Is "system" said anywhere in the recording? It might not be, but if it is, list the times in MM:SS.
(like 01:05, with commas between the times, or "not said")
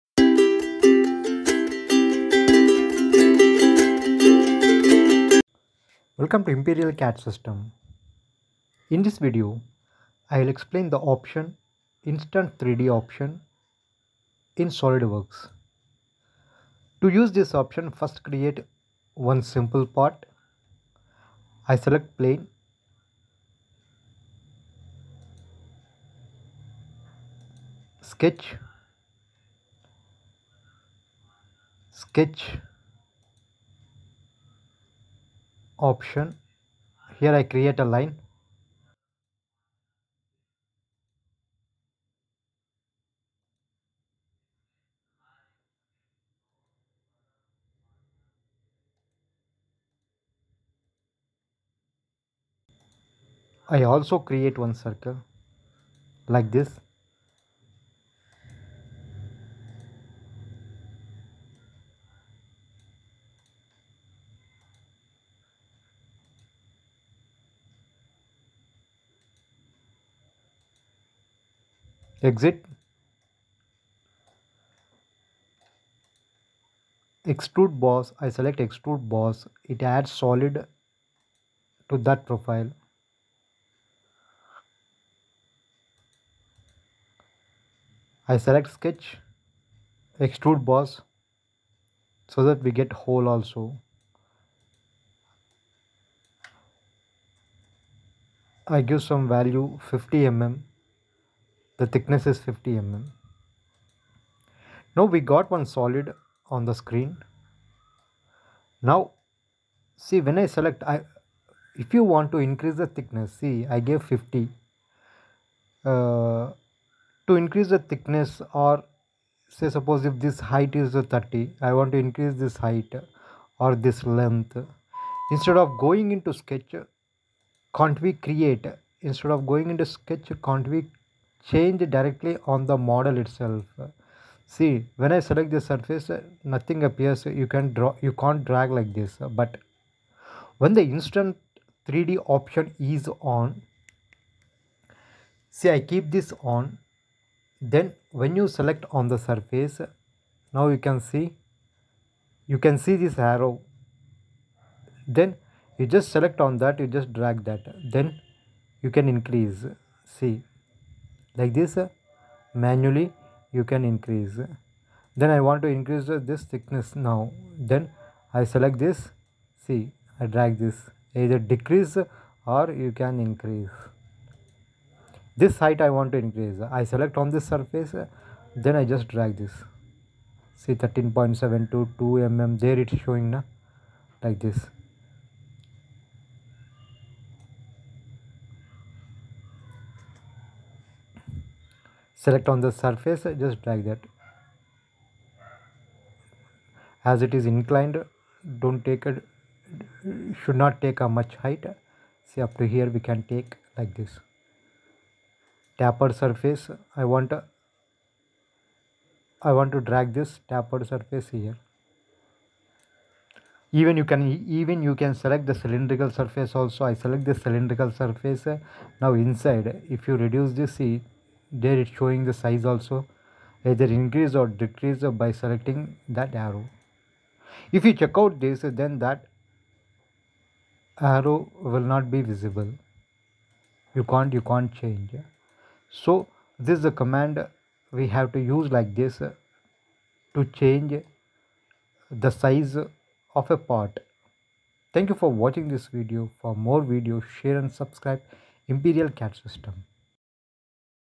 00:07, 04:09.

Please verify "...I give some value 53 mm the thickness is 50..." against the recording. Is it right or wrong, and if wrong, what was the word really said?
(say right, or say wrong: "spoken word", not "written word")
wrong: "50", not "53".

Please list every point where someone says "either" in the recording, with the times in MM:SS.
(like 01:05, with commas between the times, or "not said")
02:51, 03:43.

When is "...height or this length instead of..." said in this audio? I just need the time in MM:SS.
02:02.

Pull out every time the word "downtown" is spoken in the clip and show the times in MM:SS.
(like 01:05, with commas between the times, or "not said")
not said.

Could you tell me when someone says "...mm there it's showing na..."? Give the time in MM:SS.
03:02.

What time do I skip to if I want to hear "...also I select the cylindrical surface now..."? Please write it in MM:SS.
03:36.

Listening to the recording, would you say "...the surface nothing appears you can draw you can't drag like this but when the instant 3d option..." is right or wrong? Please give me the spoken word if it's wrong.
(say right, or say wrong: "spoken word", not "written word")
right.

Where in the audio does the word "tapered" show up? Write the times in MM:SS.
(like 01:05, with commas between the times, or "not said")
03:25, 03:30.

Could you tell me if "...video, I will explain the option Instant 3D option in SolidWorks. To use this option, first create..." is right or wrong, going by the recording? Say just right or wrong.
right.